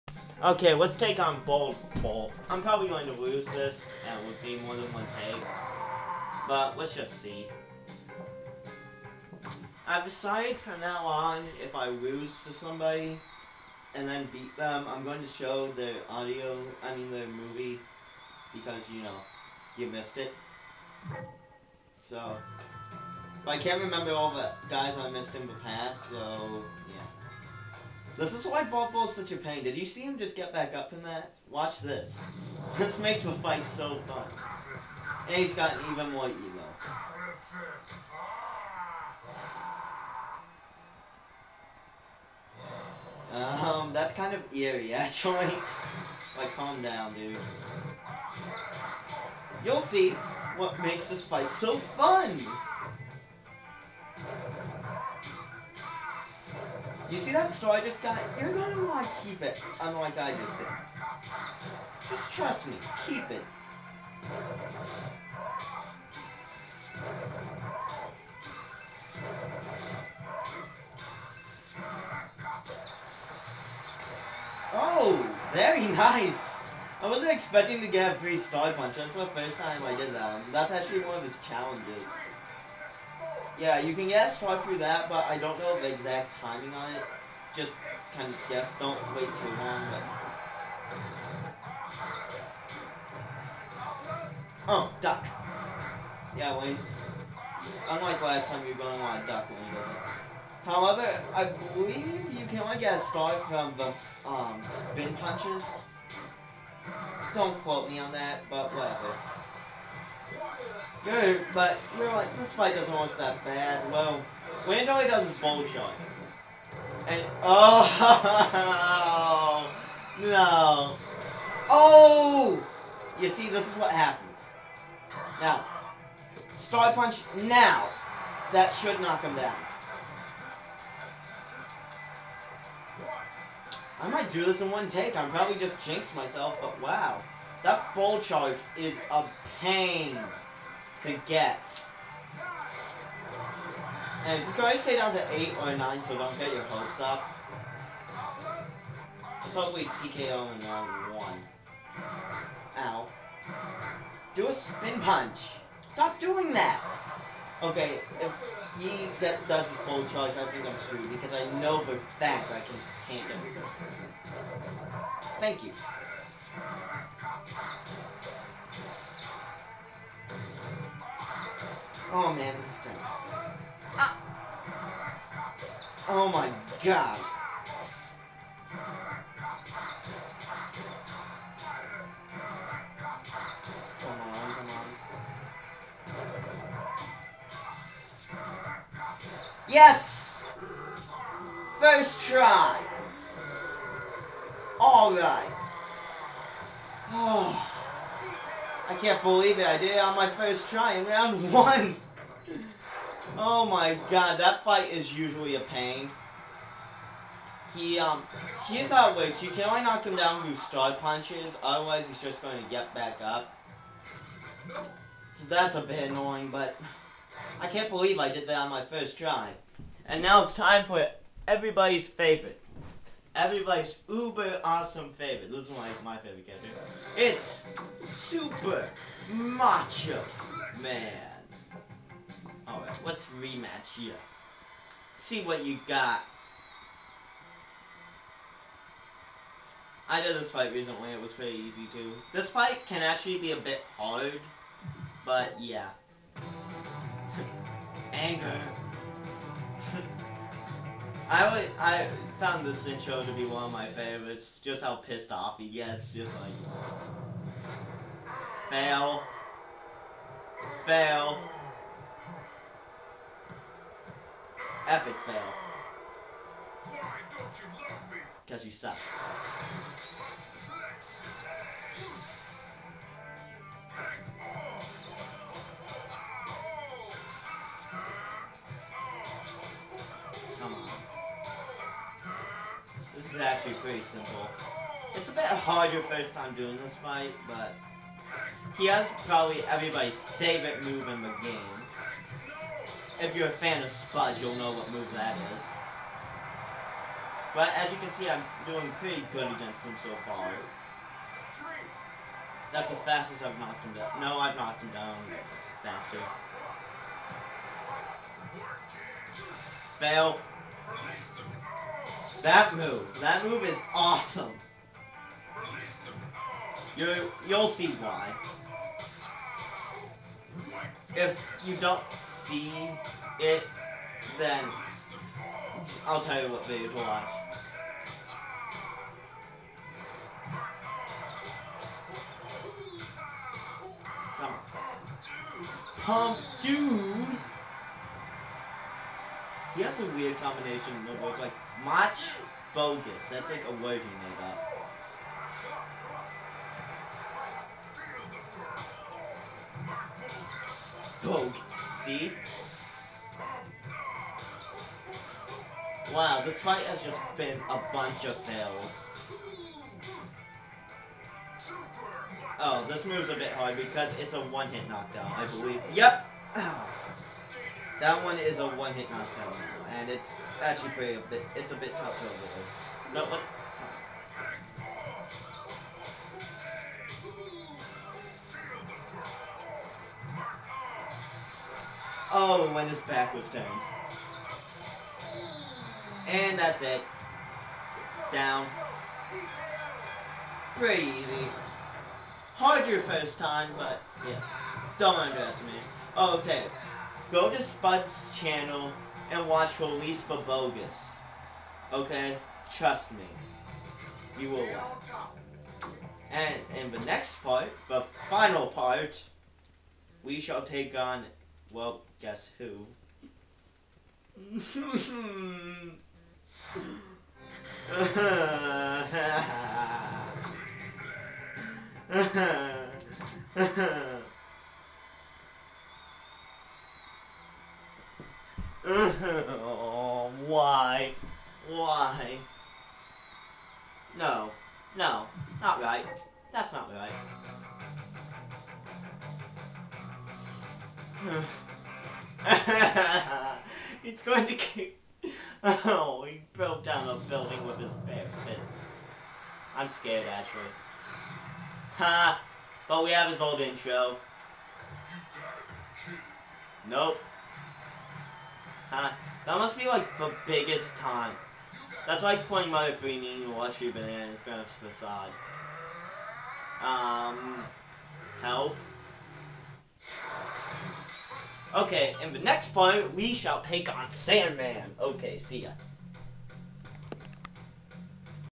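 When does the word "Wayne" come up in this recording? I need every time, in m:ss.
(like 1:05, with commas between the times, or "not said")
1:36, 1:54.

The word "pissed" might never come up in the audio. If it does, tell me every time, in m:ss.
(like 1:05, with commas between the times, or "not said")
4:14.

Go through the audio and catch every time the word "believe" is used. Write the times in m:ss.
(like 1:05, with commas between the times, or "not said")
1:41, 3:19, 3:37, 6:05.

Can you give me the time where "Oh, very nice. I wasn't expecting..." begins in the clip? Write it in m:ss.
1:14.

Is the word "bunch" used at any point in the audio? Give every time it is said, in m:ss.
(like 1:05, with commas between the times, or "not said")
5:57.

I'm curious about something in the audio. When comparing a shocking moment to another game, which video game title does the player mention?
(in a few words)
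Mother 3.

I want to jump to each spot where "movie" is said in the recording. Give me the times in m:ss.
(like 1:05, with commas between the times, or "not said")
0:17.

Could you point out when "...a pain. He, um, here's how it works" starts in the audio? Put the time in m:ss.
3:25.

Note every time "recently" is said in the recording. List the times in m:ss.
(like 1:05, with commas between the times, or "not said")
4:00.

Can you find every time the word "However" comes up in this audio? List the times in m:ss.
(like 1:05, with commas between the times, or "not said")
1:40.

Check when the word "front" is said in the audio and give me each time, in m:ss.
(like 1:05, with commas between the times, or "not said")
7:44.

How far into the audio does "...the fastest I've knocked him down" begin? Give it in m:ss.
5:02.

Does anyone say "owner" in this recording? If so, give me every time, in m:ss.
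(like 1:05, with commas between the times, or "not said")
not said.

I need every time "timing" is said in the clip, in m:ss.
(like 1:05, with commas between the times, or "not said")
1:26.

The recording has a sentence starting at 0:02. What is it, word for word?
I'm probably going to lose this.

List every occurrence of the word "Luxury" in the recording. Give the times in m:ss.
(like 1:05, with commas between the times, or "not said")
7:43.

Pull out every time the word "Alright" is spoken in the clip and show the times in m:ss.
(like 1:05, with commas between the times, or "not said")
3:14, 3:52.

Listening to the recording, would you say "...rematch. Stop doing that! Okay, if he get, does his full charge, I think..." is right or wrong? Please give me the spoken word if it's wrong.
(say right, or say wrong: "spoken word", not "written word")
wrong: "punch", not "rematch".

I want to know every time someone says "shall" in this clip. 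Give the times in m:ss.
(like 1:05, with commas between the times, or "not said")
6:50, 7:53.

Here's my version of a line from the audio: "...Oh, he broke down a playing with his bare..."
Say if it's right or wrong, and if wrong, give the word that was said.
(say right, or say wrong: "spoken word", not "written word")
wrong: "building", not "playing".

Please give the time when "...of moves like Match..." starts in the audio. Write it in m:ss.
5:41.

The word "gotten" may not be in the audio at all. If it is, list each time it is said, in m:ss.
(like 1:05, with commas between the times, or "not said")
0:35.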